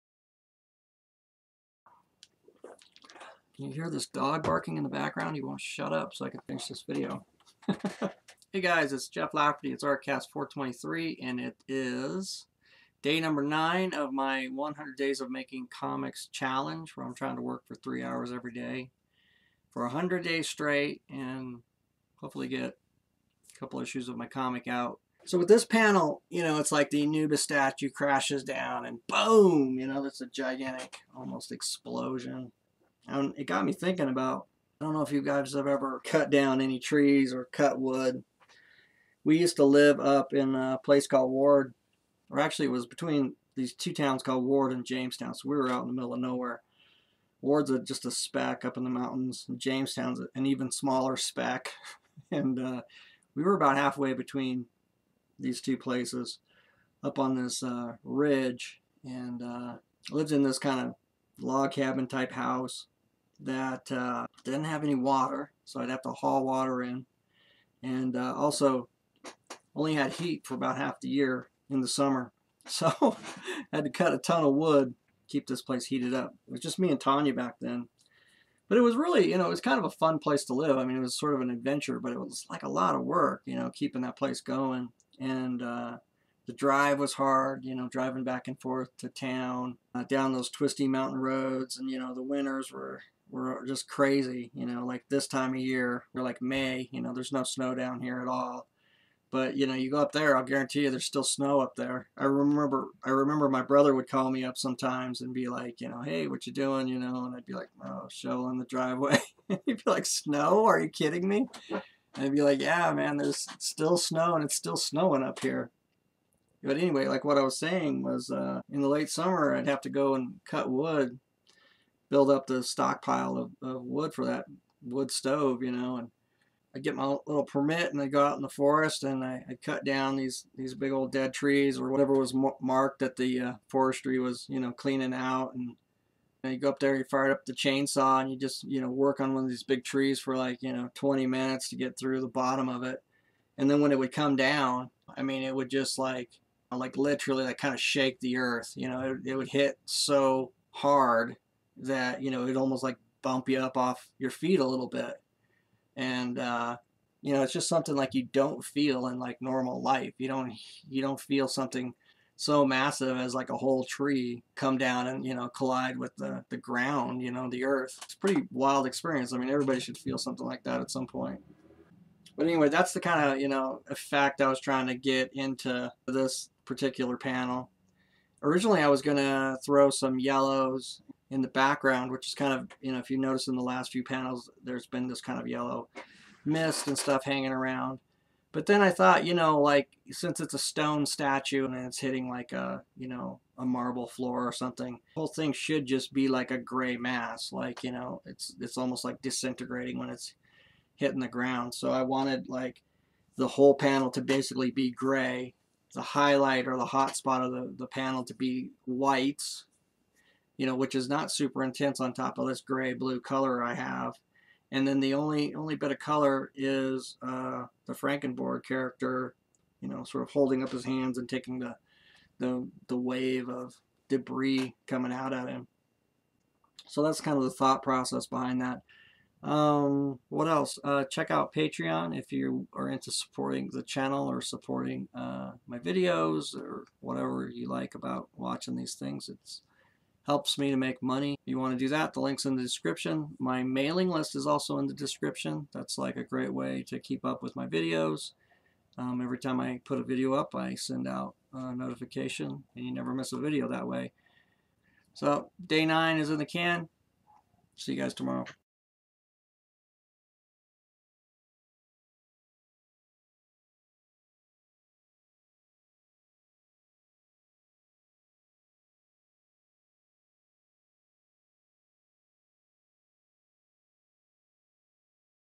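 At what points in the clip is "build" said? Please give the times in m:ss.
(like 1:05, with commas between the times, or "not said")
2:02.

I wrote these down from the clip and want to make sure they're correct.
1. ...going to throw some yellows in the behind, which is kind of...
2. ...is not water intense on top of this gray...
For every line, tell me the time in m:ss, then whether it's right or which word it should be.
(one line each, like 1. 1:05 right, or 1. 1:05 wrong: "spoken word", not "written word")
1. 2:59 wrong: "background", not "behind"
2. 3:30 wrong: "super", not "water".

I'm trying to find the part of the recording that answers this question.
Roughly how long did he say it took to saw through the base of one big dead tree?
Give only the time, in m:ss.
2:20.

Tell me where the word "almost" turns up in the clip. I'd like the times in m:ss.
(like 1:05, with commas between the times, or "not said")
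0:31, 2:32, 3:18.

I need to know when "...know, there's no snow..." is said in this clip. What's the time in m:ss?
1:37.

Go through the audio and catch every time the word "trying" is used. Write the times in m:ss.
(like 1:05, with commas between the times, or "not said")
0:17, 2:54.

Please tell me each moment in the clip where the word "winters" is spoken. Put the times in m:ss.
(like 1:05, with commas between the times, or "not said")
1:32.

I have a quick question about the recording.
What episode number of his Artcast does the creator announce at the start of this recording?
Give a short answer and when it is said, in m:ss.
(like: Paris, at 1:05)
423, at 0:09.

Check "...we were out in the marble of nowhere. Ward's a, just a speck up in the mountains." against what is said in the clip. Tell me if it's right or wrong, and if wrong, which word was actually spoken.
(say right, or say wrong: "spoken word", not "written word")
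wrong: "middle", not "marble".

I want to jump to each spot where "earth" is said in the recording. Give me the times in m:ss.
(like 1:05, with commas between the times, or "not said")
2:28, 2:47.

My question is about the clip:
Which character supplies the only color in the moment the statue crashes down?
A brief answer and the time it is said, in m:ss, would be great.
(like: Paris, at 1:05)
Frankenborg, at 3:37.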